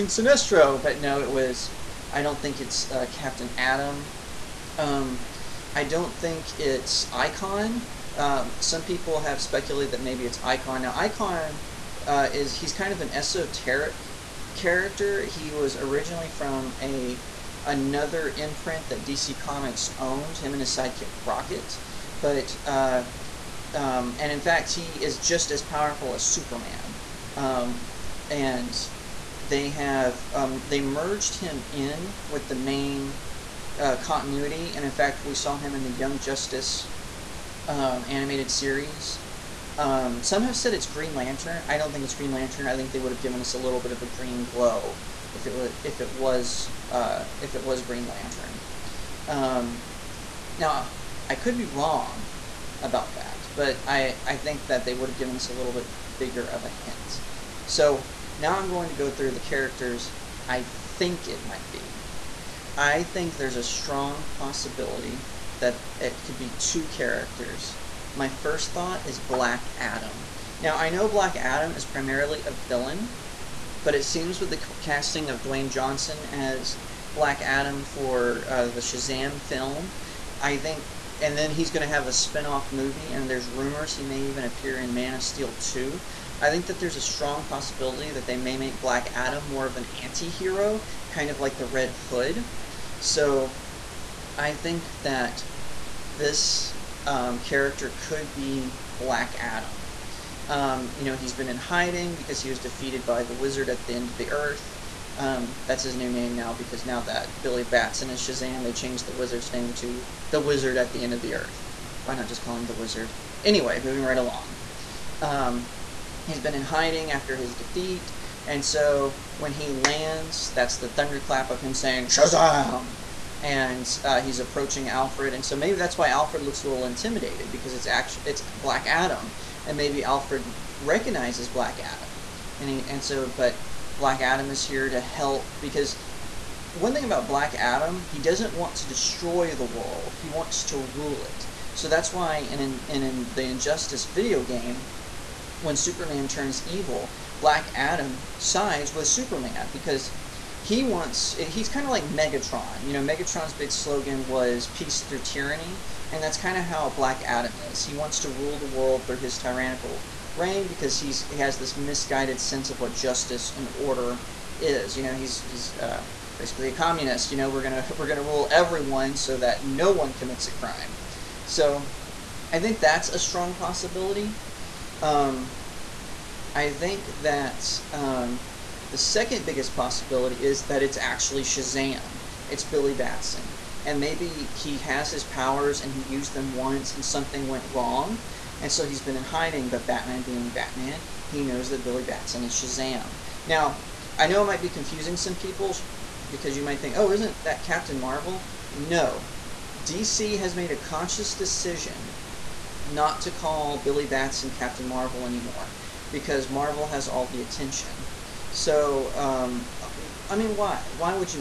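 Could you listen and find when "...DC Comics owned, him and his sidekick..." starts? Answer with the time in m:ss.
0:19.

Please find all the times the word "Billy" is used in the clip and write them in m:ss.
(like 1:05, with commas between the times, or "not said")
1:47, 3:02, 3:11, 3:23.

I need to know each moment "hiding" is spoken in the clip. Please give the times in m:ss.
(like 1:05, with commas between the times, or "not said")
1:41, 1:56, 3:09.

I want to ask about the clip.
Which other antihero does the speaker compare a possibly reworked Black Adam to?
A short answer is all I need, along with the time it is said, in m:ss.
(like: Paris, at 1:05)
Red Hood, at 1:31.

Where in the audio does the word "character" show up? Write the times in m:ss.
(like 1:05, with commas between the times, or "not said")
0:14, 0:59, 1:06, 1:37.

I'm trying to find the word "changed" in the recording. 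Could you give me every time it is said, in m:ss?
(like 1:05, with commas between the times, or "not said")
1:48.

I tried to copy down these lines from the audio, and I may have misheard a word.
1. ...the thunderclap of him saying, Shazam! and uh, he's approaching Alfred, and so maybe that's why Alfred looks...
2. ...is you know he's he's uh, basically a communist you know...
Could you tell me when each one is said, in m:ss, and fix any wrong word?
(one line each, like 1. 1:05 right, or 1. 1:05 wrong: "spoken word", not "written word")
1. 2:00 right
2. 2:44 right.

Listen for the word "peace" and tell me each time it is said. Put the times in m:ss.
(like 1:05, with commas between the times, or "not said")
2:34.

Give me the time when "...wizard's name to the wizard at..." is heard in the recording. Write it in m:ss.
1:49.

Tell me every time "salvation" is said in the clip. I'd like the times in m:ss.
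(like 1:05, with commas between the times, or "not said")
not said.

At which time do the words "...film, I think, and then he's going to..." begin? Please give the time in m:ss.
1:19.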